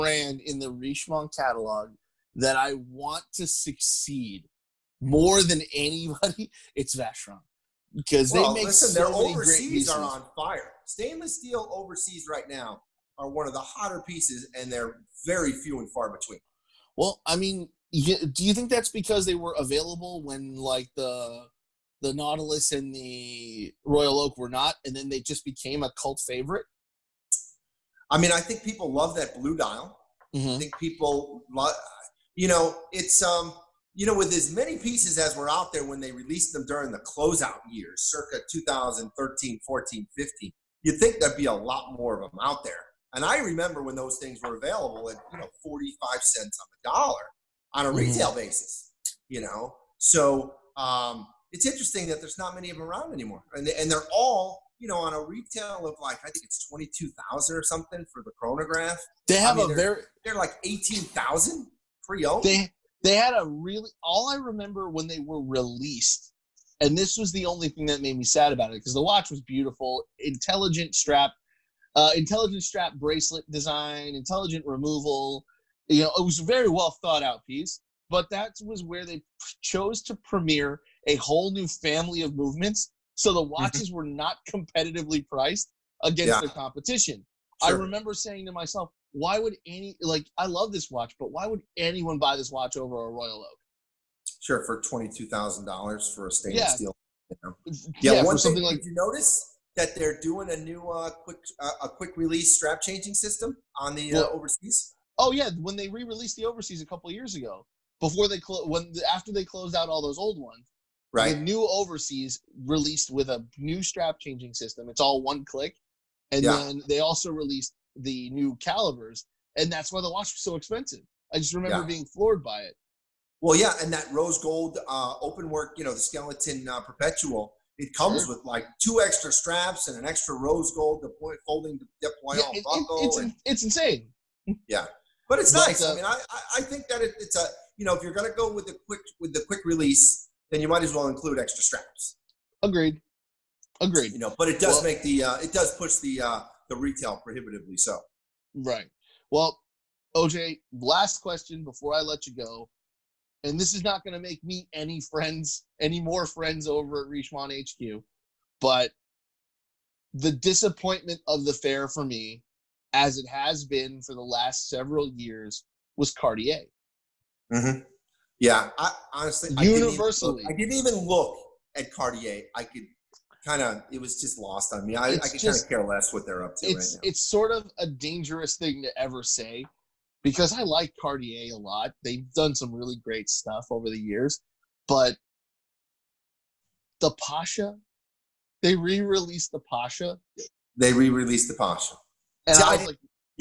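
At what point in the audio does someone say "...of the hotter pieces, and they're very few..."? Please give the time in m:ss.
0:13.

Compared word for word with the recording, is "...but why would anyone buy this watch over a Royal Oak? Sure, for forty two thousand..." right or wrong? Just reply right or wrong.
wrong.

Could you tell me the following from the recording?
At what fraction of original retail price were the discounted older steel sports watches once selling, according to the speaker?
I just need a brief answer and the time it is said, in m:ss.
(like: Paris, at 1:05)
45 cents on the dollar, at 0:45.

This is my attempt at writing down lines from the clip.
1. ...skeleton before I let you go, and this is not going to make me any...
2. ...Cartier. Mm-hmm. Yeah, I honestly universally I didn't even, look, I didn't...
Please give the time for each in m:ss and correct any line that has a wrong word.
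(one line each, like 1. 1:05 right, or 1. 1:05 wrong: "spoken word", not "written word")
1. 2:31 wrong: "question", not "skeleton"
2. 2:46 right.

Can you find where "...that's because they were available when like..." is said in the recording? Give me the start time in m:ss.
0:18.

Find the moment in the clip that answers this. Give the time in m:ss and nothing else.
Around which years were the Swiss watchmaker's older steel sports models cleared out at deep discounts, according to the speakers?
0:38.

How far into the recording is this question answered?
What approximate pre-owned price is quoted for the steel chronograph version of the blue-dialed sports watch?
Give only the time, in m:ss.
1:00.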